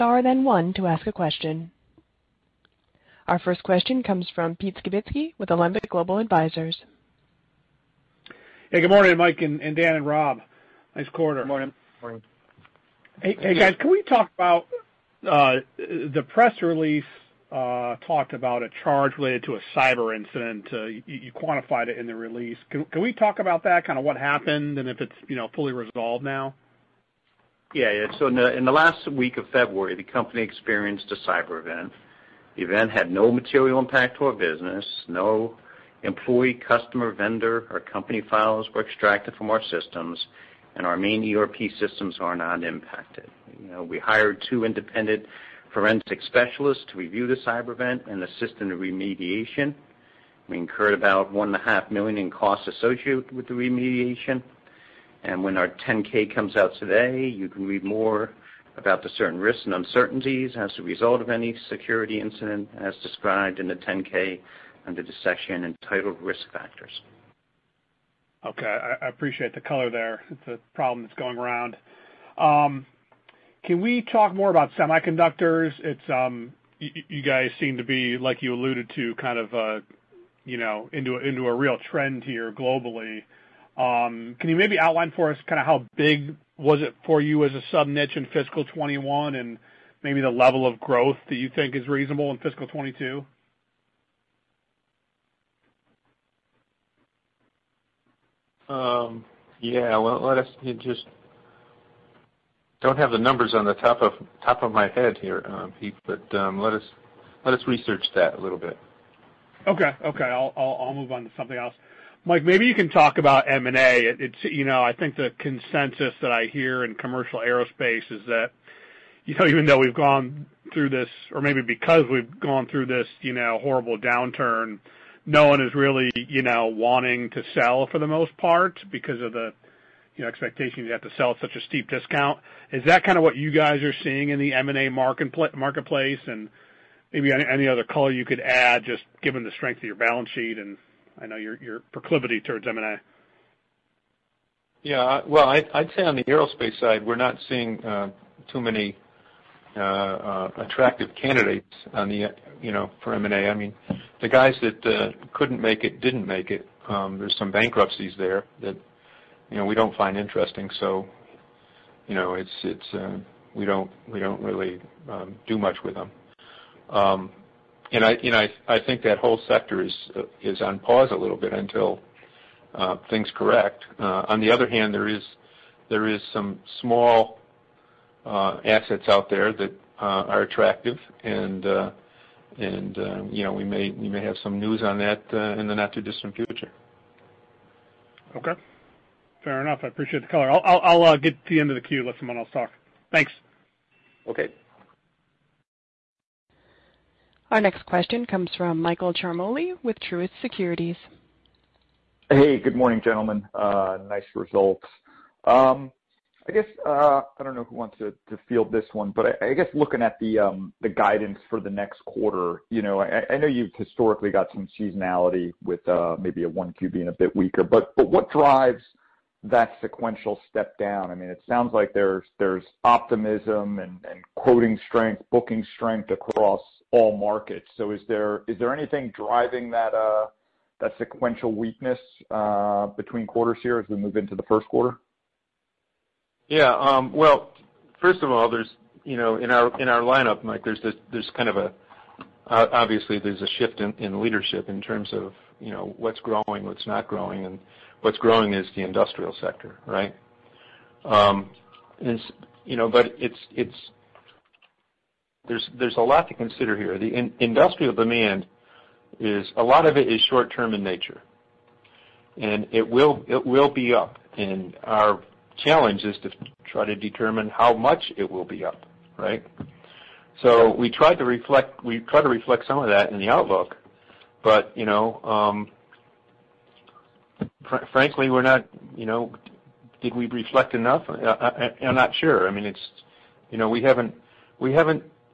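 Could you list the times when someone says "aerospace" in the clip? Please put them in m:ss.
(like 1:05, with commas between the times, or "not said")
1:57, 2:26.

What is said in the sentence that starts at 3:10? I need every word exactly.
I'll get to the end of the queue, let someone else talk.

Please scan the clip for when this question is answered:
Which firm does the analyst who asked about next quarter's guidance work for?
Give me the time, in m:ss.
3:19.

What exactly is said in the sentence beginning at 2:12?
Is that kind of what you guys are seeing in the M&A marketplace?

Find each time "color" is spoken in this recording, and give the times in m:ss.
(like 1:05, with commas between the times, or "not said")
1:09, 2:17, 3:10.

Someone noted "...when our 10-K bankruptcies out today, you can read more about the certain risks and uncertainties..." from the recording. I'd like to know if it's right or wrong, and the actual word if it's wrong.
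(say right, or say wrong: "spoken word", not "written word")
wrong: "comes", not "bankruptcies".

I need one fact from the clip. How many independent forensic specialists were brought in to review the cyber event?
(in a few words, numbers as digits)
2.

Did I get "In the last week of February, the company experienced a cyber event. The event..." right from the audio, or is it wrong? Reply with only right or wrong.
right.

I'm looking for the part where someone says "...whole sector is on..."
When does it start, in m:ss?
2:49.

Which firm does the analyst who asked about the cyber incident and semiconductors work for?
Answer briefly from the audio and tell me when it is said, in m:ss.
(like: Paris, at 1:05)
Alembic Global Advisors, at 0:05.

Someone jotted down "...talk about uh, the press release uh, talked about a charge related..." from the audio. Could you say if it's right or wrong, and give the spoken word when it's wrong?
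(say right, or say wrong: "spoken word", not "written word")
right.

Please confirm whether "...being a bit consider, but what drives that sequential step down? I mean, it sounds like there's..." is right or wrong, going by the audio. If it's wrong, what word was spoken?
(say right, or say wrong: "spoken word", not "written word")
wrong: "weaker", not "consider".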